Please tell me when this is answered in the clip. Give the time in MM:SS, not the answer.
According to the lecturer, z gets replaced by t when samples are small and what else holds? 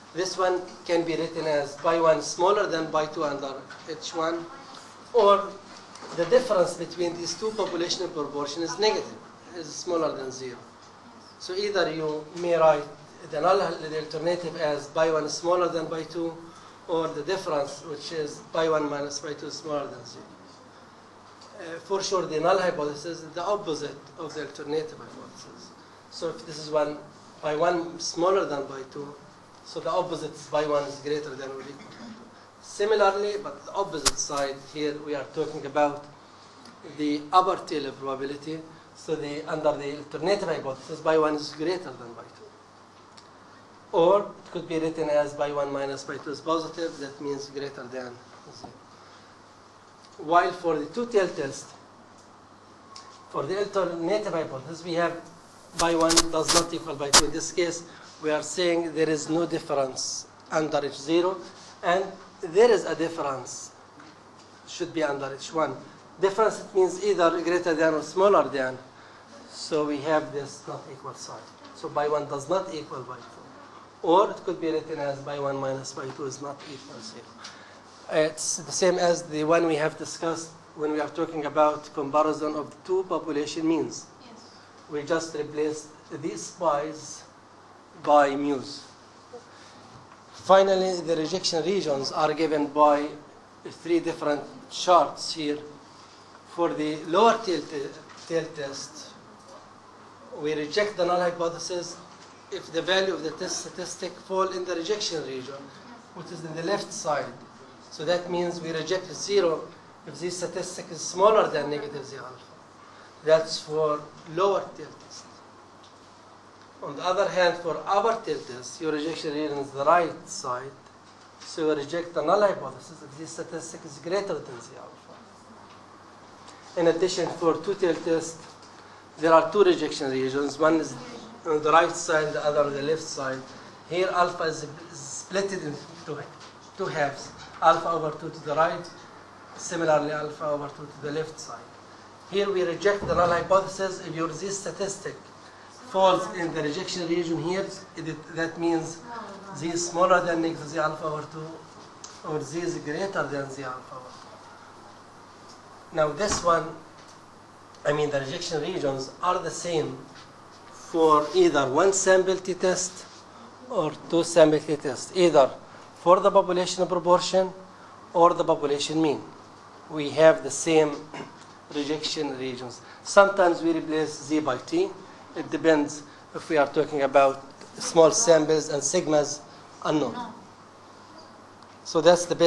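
02:58.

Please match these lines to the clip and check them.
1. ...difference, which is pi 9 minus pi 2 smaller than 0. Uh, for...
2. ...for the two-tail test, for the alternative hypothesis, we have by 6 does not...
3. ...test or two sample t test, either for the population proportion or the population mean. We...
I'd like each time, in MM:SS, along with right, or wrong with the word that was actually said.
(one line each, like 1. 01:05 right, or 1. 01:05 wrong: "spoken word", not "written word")
1. 00:17 wrong: "1", not "9"
2. 00:50 wrong: "1", not "6"
3. 02:42 right.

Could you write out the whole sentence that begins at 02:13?
Here alpha is split into two halves, alpha over 2 to the right, similarly alpha over 2 to the left side.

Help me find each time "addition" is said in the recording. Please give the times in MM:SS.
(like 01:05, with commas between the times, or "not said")
02:06.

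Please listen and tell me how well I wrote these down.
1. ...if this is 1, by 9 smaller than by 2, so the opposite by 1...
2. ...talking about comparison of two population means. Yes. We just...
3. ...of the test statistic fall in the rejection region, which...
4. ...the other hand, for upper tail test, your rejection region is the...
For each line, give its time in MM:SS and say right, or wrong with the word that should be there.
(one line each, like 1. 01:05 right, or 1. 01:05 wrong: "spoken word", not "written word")
1. 00:26 wrong: "1", not "9"
2. 01:21 right
3. 01:43 right
4. 01:56 right.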